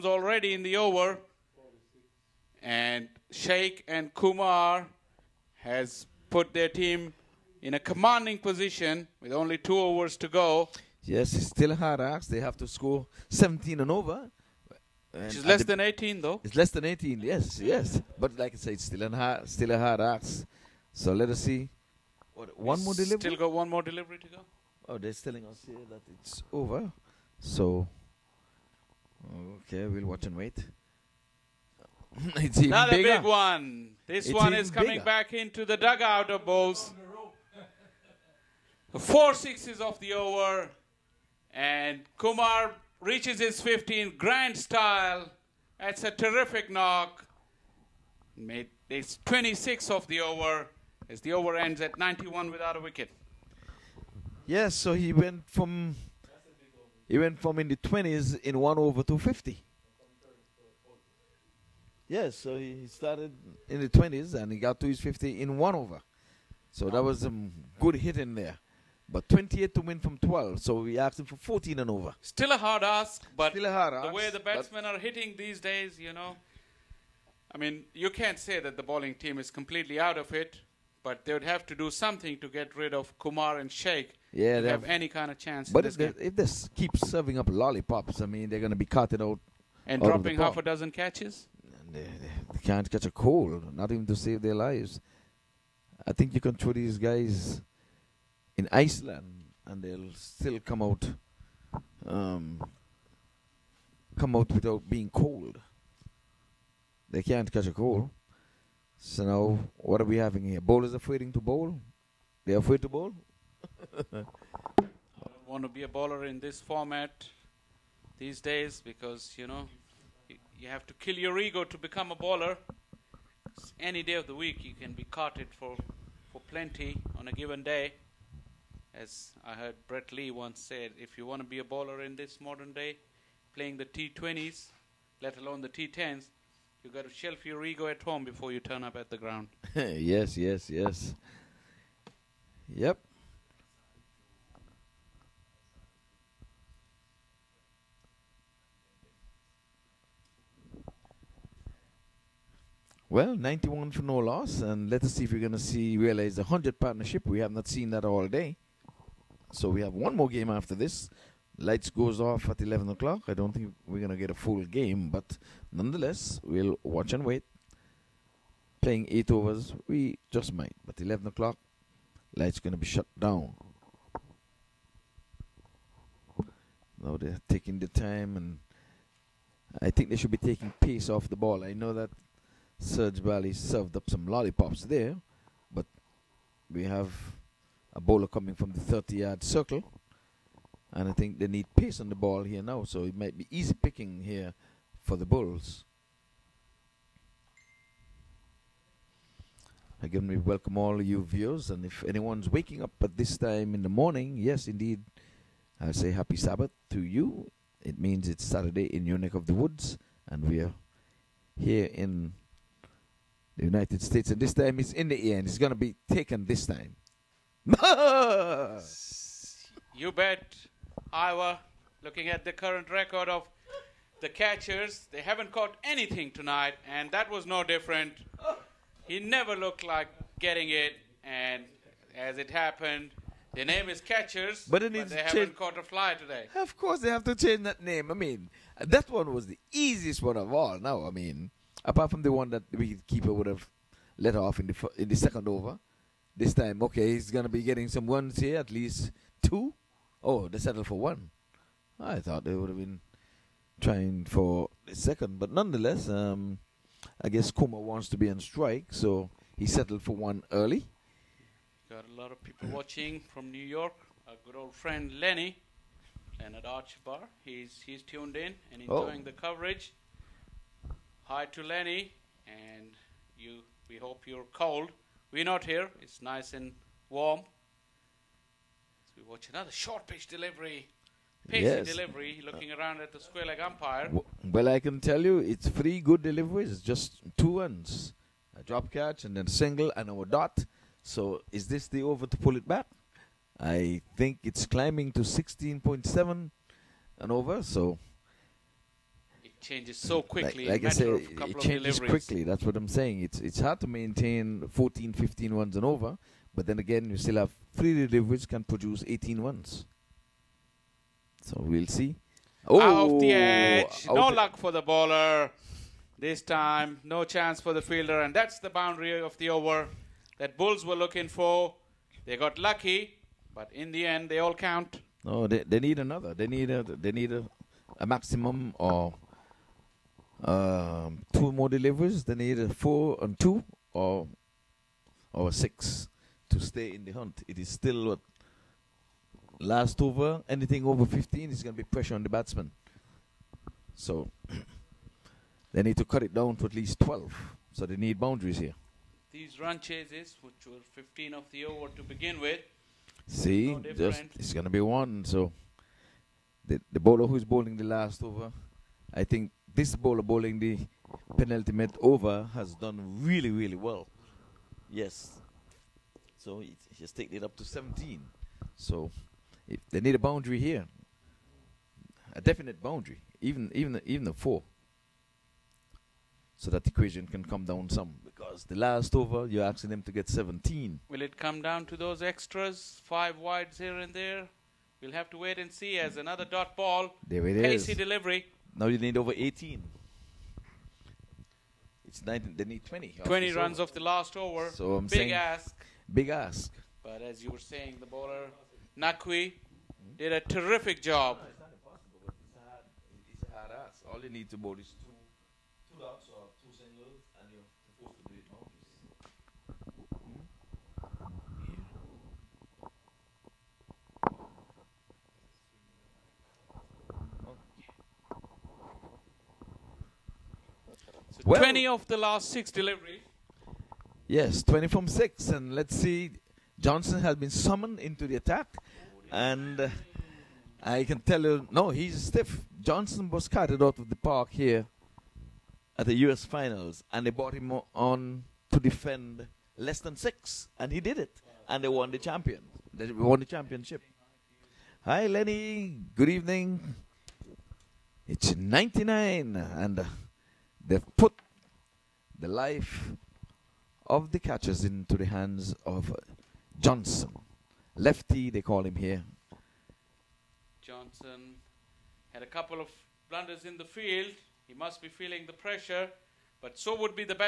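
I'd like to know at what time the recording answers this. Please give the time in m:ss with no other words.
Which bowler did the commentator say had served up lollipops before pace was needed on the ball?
3:02.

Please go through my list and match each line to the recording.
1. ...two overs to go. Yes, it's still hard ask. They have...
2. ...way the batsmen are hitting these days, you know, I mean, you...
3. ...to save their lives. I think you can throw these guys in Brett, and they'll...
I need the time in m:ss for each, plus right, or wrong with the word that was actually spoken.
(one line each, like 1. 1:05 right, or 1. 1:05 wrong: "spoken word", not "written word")
1. 0:09 right
2. 1:14 right
3. 1:34 wrong: "Iceland", not "Brett".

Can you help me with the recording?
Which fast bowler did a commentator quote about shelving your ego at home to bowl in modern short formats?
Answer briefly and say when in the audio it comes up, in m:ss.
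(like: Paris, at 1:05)
Brett Lee, at 2:09.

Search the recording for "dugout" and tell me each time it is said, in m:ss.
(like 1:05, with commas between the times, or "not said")
0:35.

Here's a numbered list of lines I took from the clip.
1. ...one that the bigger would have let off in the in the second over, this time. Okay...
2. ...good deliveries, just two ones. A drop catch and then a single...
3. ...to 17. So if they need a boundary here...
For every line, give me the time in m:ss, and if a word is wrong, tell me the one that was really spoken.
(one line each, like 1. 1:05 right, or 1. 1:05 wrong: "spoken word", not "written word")
1. 4:02 wrong: "keeper", not "bigger"
2. 4:45 right
3. 6:07 right.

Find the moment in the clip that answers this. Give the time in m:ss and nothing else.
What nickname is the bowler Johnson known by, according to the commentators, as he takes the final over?
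7:37.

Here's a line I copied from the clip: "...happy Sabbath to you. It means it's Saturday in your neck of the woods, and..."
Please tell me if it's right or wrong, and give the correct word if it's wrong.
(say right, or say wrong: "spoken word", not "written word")
right.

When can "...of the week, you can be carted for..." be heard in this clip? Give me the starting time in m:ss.
2:04.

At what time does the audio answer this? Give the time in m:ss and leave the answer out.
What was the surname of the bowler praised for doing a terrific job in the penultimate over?
6:38.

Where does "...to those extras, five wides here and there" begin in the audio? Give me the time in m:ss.
6:21.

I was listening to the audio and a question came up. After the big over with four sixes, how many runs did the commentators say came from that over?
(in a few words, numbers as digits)
26.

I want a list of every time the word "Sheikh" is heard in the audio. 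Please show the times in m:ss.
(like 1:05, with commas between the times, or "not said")
0:03, 1:23.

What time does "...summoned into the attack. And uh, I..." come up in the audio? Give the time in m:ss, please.
7:07.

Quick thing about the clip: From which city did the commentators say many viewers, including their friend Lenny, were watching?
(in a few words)
New York.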